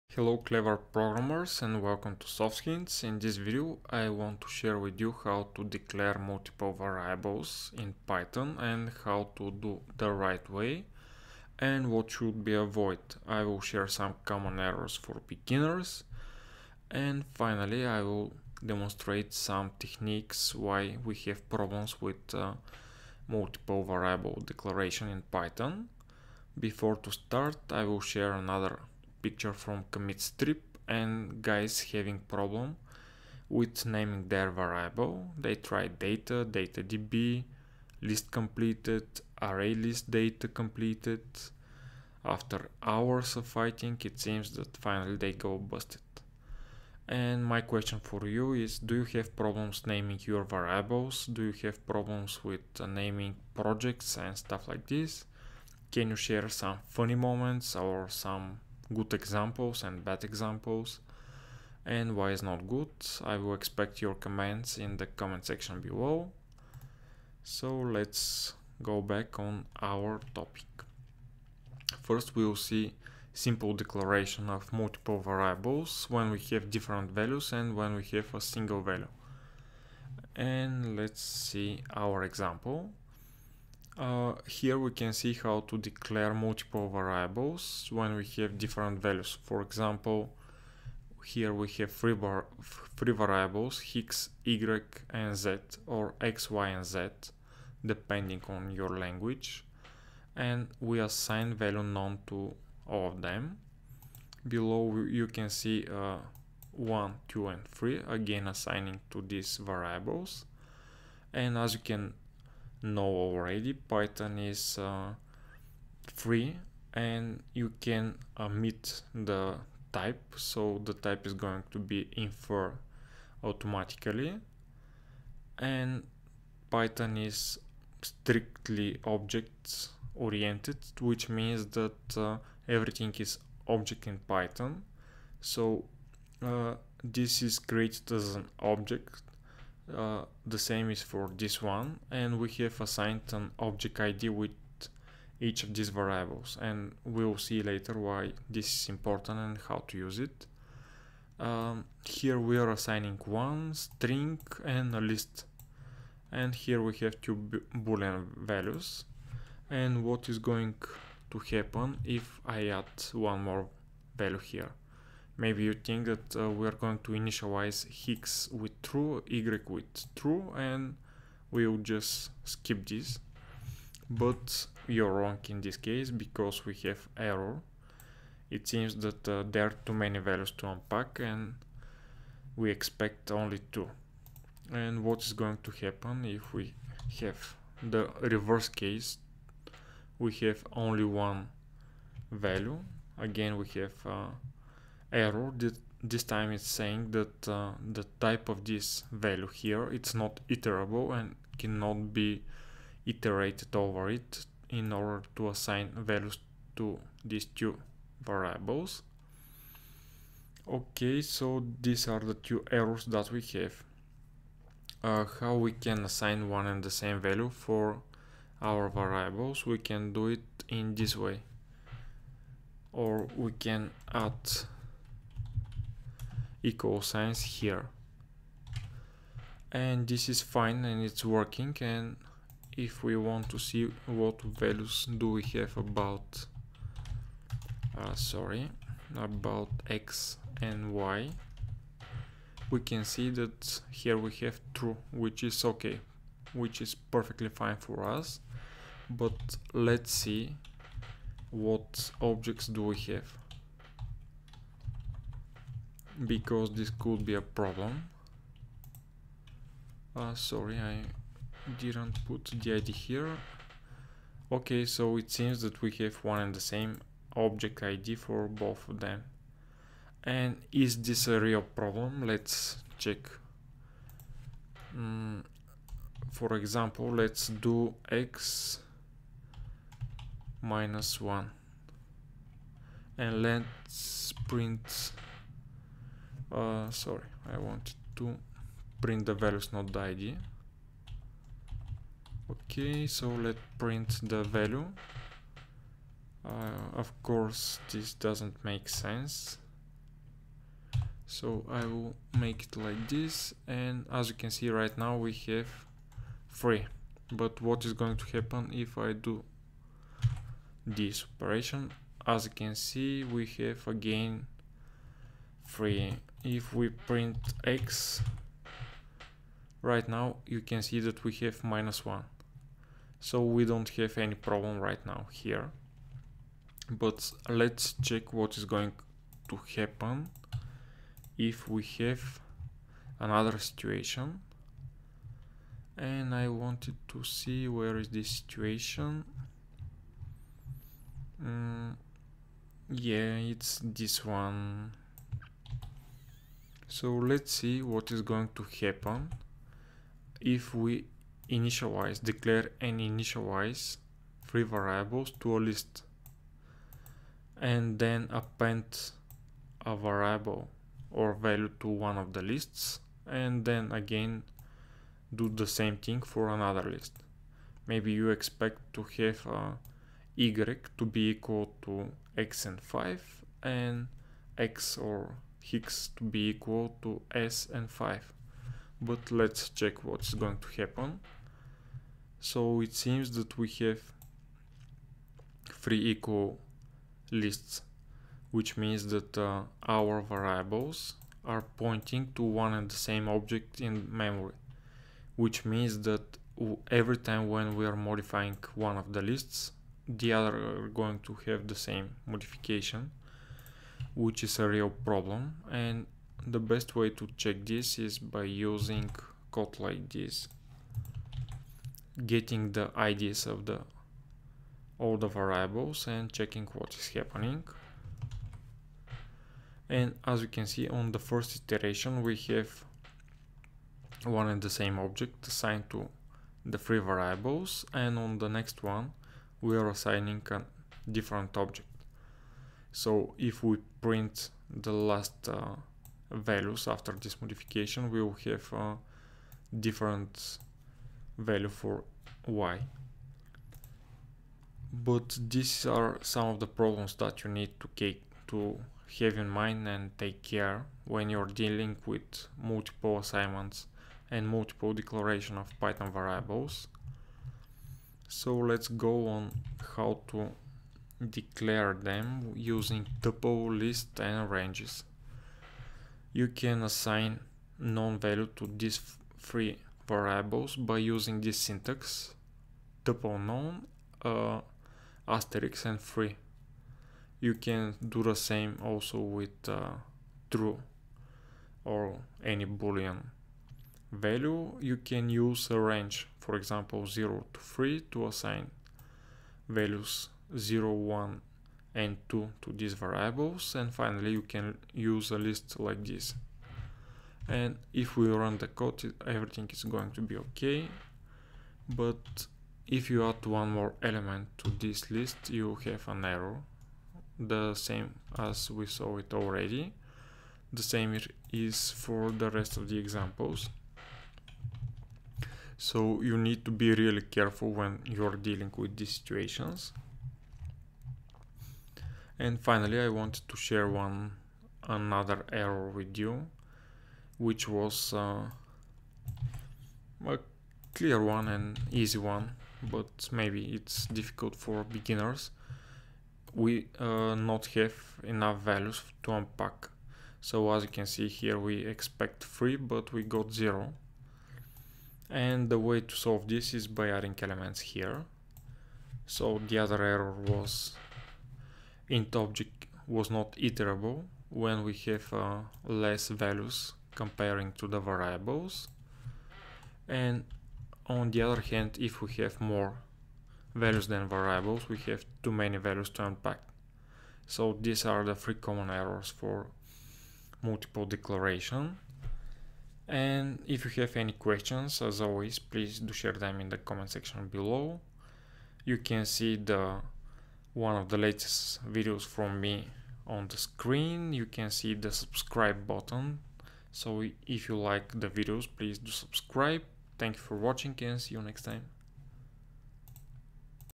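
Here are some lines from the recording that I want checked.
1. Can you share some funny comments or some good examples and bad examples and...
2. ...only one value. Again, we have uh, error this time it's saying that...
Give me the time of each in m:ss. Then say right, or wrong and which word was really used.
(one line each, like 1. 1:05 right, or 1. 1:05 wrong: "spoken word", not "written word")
1. 0:55 wrong: "moments", not "comments"
2. 3:10 right.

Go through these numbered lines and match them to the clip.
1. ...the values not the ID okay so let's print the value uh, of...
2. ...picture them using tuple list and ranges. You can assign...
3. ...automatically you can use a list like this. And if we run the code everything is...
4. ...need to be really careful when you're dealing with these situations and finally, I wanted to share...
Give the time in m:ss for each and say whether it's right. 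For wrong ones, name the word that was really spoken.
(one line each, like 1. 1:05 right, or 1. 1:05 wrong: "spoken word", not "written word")
1. 4:49 right
2. 7:41 wrong: "declare", not "picture"
3. 8:13 wrong: "finally", not "automatically"
4. 8:36 right.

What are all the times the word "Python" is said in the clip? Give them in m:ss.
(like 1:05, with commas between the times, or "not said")
0:08, 0:25, 1:53, 2:06, 2:14, 7:35.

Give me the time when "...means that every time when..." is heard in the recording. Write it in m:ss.
6:35.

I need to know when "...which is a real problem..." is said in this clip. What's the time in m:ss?
6:44.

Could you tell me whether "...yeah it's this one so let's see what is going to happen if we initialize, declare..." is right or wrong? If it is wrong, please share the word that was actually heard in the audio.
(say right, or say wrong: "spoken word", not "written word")
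right.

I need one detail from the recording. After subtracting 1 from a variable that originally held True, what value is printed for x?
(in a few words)
-1.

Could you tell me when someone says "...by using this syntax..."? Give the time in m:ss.
7:50.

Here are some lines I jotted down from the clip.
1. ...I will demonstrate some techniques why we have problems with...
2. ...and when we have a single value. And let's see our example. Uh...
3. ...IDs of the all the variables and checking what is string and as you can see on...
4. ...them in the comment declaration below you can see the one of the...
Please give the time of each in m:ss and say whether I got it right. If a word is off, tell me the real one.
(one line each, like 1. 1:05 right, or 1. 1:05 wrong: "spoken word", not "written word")
1. 0:17 right
2. 1:17 right
3. 6:52 wrong: "happening", not "string"
4. 9:36 wrong: "section", not "declaration".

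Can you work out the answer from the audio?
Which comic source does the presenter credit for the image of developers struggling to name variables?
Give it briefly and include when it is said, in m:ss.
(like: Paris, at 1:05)
CommitStrip, at 0:29.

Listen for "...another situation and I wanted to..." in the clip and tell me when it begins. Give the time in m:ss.
5:33.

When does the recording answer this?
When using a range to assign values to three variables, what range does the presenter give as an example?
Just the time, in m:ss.
8:07.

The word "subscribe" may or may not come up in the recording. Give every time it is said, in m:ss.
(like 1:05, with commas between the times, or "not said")
9:45, 9:49.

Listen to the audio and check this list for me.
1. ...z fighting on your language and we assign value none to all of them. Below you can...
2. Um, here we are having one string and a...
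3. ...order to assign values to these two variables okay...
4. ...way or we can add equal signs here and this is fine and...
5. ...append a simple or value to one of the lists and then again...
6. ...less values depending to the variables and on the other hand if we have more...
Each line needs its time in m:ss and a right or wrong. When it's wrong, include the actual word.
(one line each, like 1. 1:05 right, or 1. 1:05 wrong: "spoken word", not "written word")
1. 1:36 wrong: "depending", not "fighting"
2. 2:31 wrong: "assigning", not "having"
3. 3:24 right
4. 3:41 right
5. 5:58 wrong: "variable", not "simple"
6. 9:15 wrong: "comparing", not "depending".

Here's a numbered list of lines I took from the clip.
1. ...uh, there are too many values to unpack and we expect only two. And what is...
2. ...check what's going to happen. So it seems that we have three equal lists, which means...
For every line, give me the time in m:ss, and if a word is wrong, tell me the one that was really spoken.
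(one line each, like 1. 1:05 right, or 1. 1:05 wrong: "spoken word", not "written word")
1. 2:59 right
2. 6:19 right.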